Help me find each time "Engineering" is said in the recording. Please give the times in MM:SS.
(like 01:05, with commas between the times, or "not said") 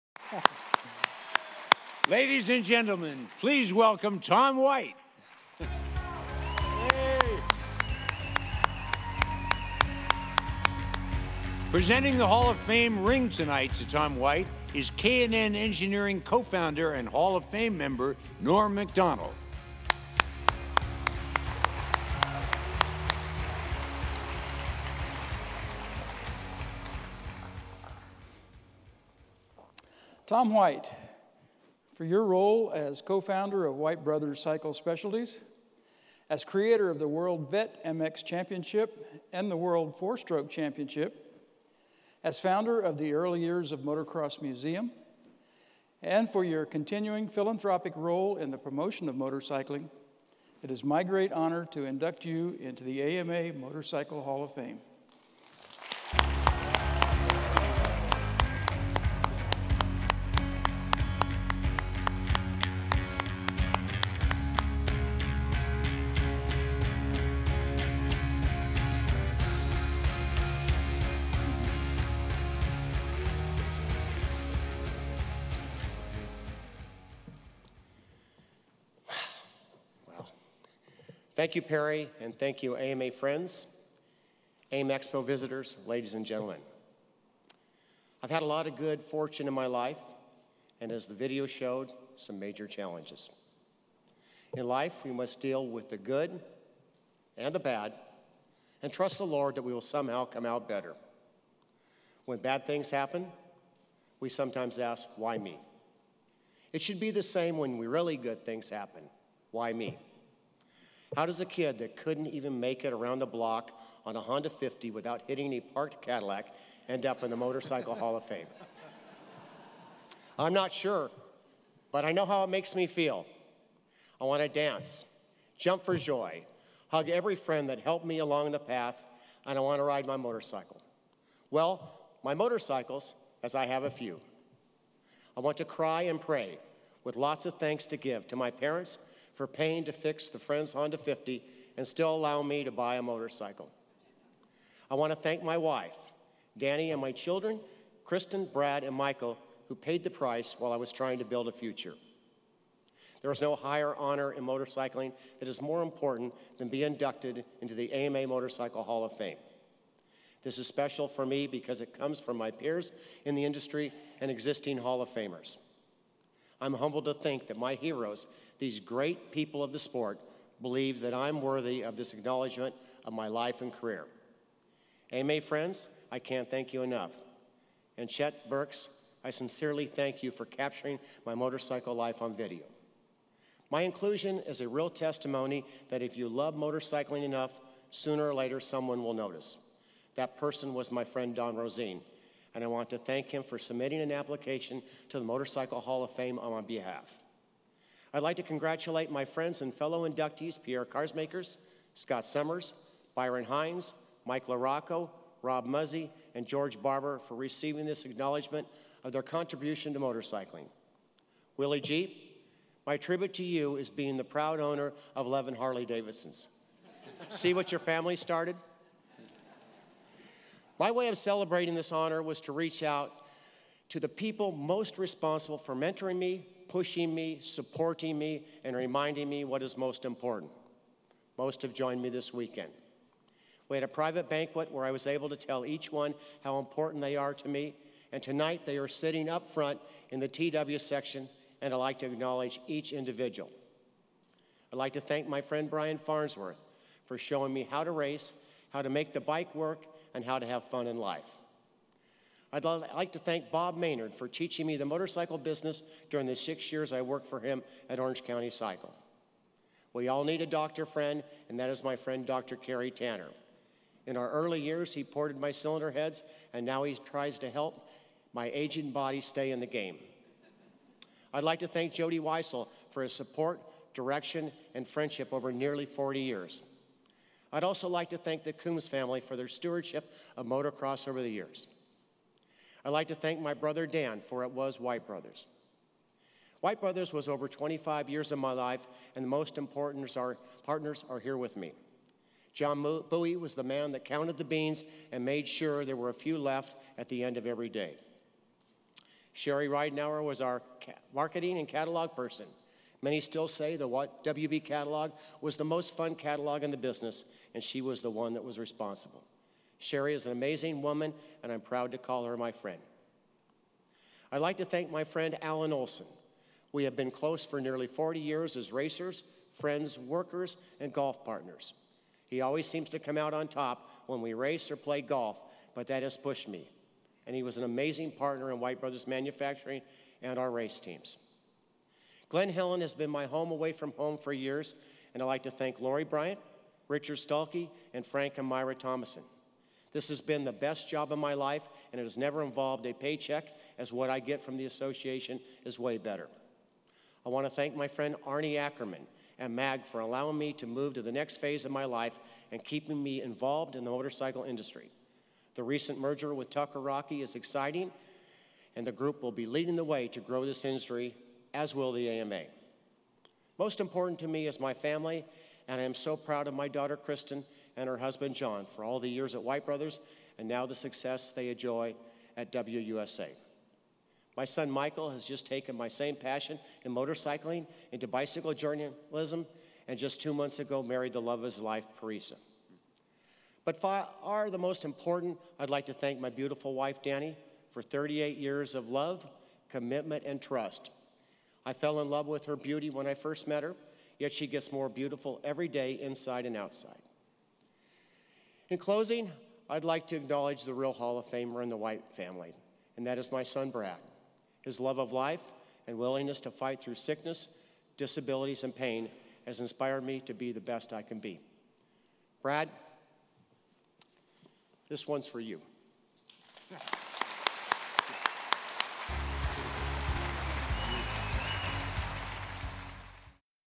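00:15.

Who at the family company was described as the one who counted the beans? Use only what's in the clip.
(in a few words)
John Bowie.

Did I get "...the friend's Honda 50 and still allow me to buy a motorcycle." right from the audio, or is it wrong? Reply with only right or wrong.
right.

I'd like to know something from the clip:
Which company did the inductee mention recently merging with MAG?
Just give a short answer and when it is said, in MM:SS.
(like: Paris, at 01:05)
Tucker Rocky, at 05:56.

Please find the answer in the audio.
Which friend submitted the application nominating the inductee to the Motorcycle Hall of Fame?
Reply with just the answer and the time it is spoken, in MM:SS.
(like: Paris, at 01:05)
Don Rosine, at 03:11.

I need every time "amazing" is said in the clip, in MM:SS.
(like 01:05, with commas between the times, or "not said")
05:10, 05:27.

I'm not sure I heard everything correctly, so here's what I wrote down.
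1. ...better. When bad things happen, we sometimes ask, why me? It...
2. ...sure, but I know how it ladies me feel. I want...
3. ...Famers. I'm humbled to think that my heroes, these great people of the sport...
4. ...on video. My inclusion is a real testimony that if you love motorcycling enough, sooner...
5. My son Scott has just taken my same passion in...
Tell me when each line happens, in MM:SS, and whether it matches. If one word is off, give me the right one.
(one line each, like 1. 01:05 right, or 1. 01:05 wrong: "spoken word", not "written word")
1. 01:40 right
2. 02:00 wrong: "makes", not "ladies"
3. 02:45 right
4. 03:02 right
5. 06:14 wrong: "Michael", not "Scott".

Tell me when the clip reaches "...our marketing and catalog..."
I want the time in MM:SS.
05:00.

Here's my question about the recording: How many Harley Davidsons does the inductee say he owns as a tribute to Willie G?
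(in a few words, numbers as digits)
11.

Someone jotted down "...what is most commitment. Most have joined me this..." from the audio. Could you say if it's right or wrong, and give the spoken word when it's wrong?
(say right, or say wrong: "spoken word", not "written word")
wrong: "important", not "commitment".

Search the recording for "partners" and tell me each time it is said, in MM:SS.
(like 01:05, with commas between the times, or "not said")
04:50, 05:21, 05:28.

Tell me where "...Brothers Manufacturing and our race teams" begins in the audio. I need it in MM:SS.
05:28.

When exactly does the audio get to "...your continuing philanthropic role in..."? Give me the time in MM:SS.
00:46.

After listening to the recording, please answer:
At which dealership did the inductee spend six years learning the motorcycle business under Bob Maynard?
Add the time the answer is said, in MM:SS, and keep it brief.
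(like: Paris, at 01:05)
Orange County Cycle, at 04:17.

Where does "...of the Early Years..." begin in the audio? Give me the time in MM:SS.
00:42.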